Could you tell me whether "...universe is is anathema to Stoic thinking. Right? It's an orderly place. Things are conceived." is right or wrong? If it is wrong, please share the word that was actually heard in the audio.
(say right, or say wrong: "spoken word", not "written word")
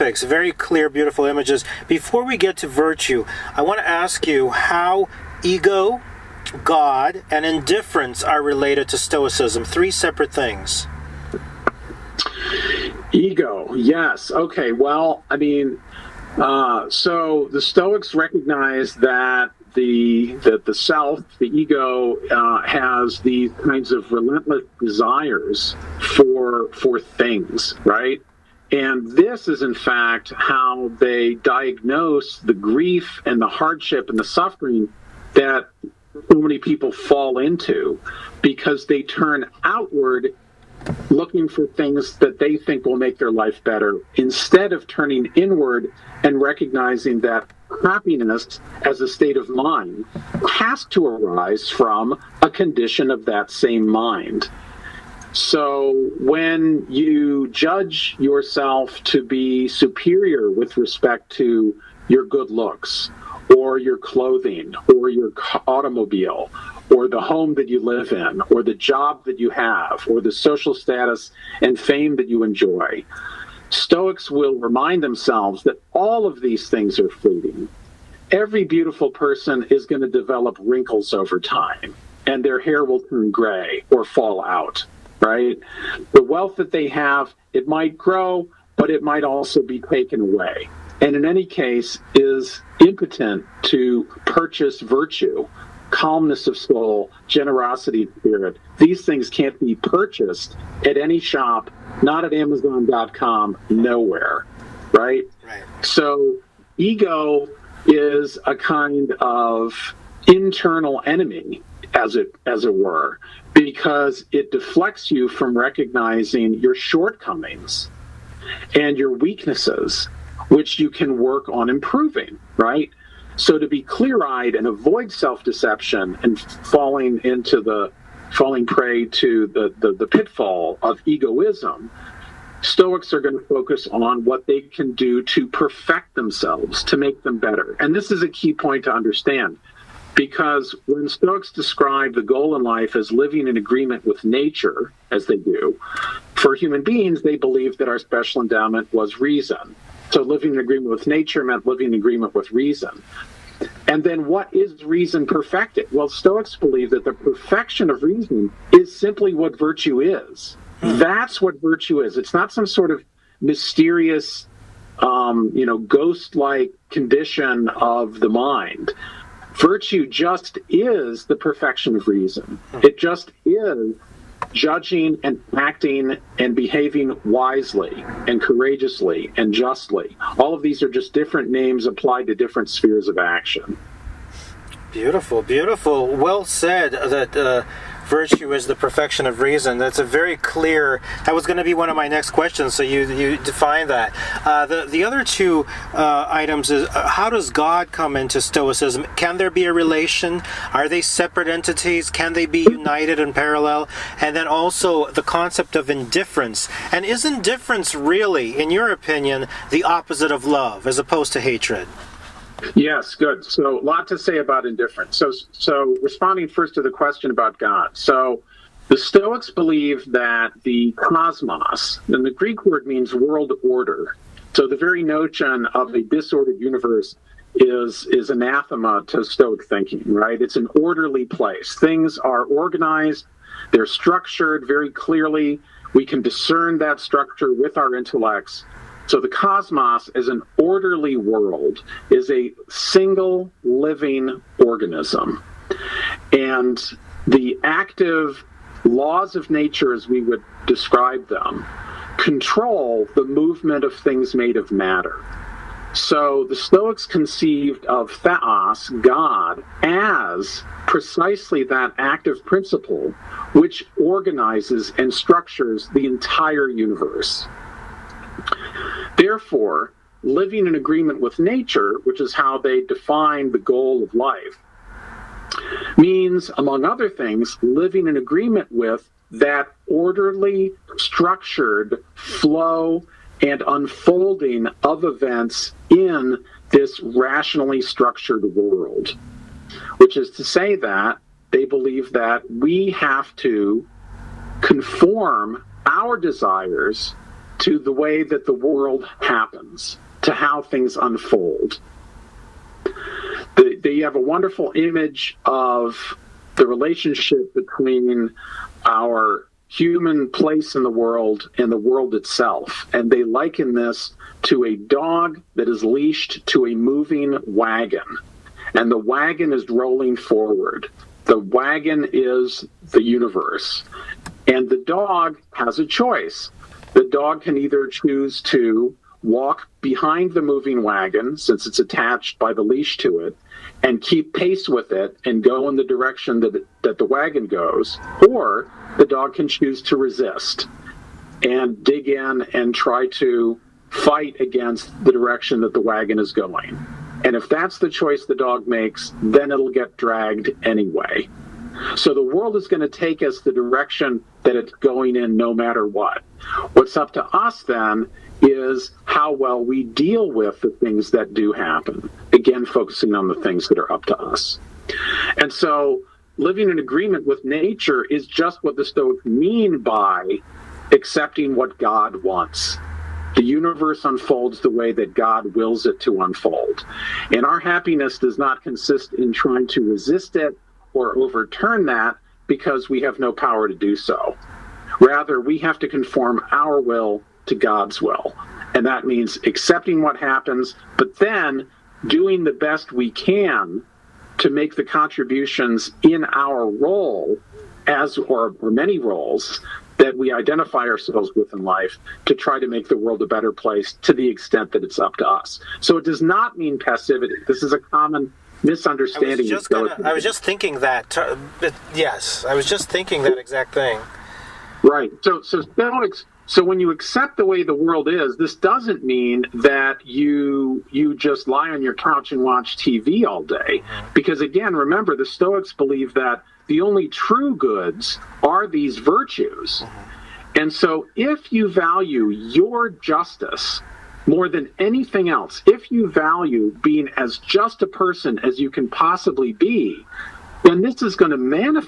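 wrong: "organized", not "conceived".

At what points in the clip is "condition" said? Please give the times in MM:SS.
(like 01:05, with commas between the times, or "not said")
00:52, 02:46.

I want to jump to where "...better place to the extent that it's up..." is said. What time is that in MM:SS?
06:43.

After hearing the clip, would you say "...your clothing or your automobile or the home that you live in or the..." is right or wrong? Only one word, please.
right.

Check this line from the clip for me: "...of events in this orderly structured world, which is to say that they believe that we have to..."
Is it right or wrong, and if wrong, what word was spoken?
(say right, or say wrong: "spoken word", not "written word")
wrong: "rationally", not "orderly".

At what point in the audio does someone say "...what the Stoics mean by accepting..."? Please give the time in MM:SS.
06:08.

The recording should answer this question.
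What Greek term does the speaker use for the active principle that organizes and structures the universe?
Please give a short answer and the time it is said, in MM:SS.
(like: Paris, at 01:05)
Theos, at 04:18.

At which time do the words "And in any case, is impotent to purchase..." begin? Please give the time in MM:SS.
01:30.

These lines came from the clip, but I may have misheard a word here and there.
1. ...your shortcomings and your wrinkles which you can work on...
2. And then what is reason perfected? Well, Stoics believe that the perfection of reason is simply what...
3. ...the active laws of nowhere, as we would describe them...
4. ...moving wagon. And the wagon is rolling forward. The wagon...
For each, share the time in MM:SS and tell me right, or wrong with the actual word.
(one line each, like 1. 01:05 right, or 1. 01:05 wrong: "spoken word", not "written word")
1. 01:56 wrong: "weaknesses", not "wrinkles"
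2. 02:33 right
3. 04:07 wrong: "nature", not "nowhere"
4. 05:16 right.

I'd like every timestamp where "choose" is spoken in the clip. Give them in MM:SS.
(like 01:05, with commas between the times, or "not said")
05:27, 05:39.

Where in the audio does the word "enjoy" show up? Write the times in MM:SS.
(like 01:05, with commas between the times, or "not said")
01:12.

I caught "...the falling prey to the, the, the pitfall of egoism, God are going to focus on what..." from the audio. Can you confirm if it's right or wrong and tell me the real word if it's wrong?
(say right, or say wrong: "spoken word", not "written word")
wrong: "Stoics", not "God".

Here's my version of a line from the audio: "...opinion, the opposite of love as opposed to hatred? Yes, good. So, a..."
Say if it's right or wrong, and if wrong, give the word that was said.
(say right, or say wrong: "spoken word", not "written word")
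right.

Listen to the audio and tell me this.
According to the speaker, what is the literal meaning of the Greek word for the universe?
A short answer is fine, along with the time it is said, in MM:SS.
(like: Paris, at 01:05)
World order, at 03:43.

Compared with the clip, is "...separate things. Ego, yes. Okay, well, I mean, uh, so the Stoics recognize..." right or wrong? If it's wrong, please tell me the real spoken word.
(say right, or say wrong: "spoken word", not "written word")
right.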